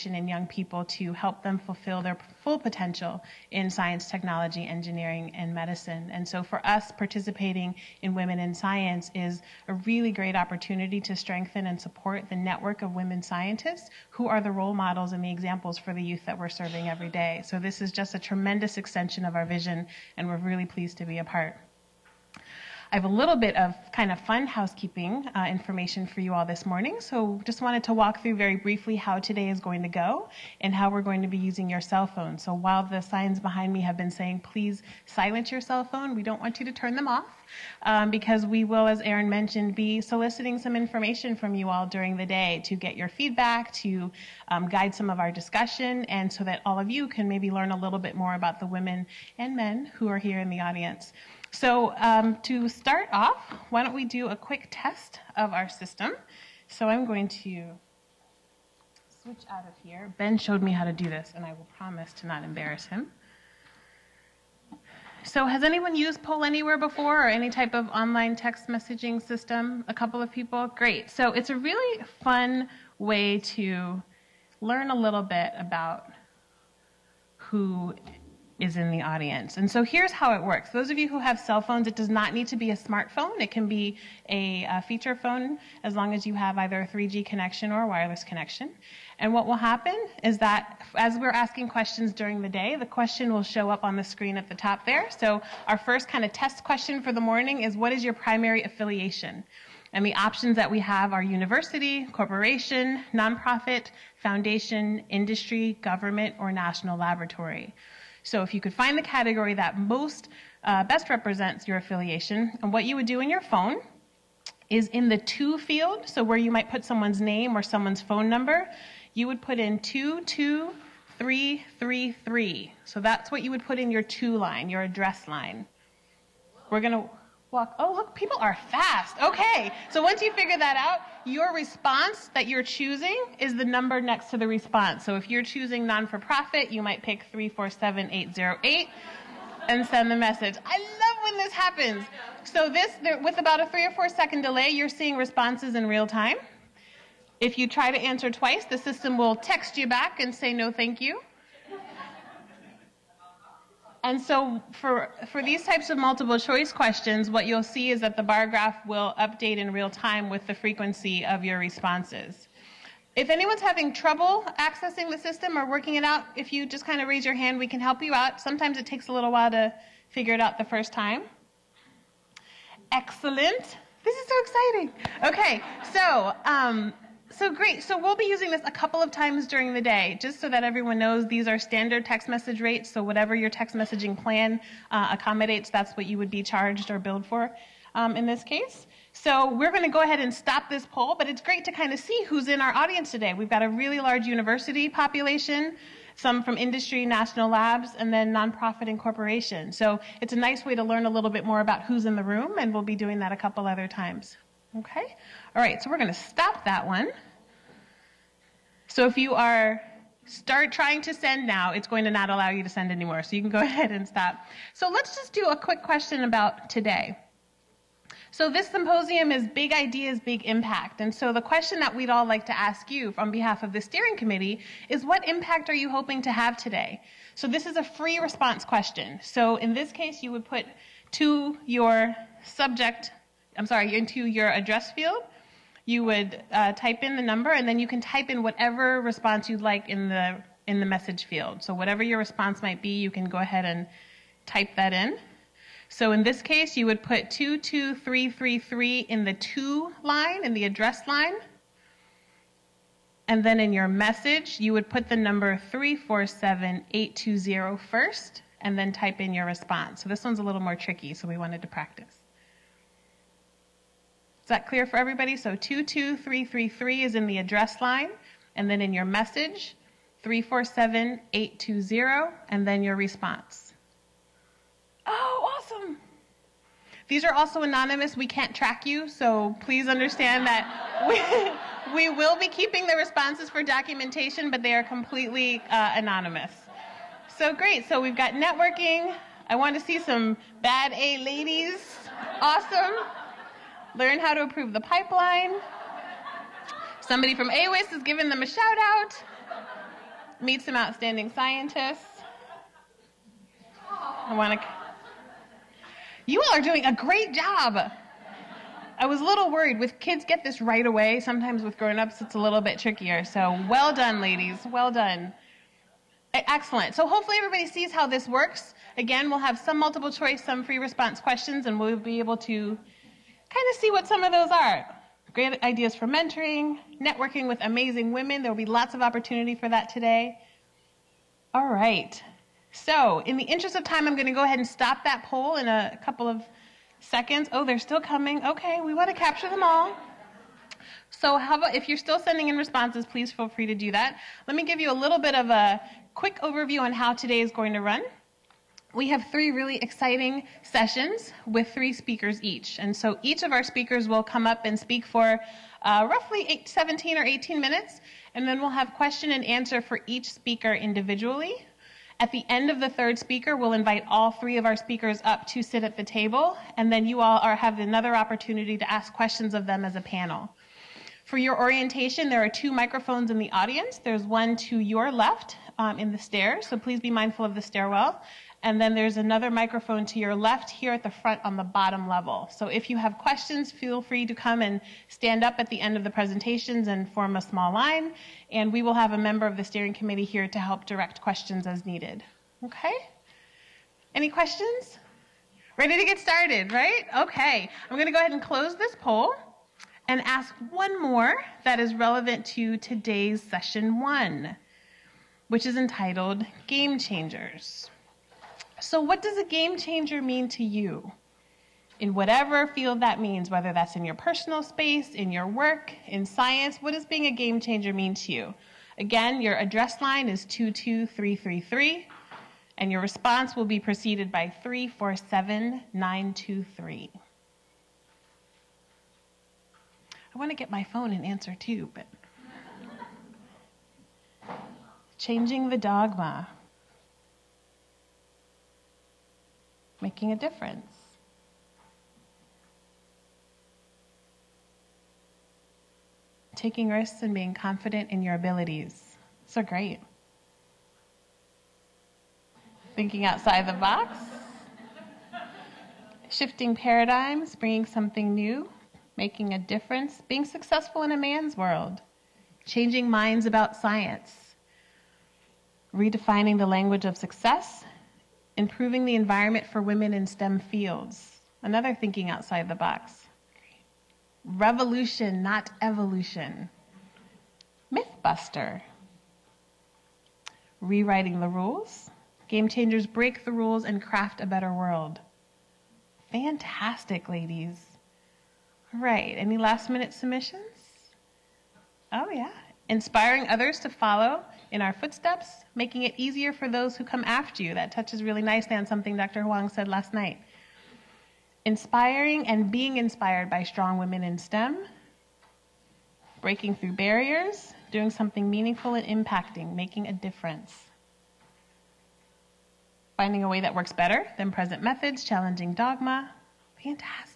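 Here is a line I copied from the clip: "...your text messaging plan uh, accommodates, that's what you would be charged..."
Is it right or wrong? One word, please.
right.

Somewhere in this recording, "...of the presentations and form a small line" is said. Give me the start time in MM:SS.
06:25.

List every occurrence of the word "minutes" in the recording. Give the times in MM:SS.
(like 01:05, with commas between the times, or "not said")
05:57, 08:09.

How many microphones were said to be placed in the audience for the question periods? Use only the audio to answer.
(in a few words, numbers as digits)
2.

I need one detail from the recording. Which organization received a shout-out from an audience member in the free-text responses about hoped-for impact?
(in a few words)
AWIS.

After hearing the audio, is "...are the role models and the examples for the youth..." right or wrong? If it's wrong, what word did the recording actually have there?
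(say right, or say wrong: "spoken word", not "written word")
right.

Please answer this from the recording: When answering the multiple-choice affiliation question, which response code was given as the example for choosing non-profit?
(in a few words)
347808.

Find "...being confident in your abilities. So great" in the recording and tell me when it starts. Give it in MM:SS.
07:27.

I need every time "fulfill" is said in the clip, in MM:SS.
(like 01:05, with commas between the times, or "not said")
00:01.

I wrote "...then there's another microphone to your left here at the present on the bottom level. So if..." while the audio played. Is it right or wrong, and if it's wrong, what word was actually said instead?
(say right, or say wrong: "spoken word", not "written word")
wrong: "front", not "present".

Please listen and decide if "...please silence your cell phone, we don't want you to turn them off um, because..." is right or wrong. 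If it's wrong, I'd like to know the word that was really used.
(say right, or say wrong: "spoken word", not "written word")
right.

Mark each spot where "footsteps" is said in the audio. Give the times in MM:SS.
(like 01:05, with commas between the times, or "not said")
08:14.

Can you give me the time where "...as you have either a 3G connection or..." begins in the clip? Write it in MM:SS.
01:26.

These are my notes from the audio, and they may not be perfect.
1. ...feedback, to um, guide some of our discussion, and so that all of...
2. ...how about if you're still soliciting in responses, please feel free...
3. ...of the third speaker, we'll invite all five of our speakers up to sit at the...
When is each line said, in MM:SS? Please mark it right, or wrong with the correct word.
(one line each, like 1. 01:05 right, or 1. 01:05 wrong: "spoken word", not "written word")
1. 00:43 right
2. 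05:41 wrong: "sending", not "soliciting"
3. 06:02 wrong: "three", not "five".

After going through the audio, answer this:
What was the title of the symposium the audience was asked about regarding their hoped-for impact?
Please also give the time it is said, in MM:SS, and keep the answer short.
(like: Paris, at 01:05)
Big Ideas, Big Impact, at 03:39.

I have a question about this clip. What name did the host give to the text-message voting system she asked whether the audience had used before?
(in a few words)
Poll Anywhere.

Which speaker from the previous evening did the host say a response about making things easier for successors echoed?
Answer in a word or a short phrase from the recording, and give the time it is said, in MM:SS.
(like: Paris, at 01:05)
Dr. Huang, at 08:19.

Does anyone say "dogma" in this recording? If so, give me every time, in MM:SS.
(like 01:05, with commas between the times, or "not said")
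07:15, 08:35.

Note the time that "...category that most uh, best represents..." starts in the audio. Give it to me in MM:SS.
01:49.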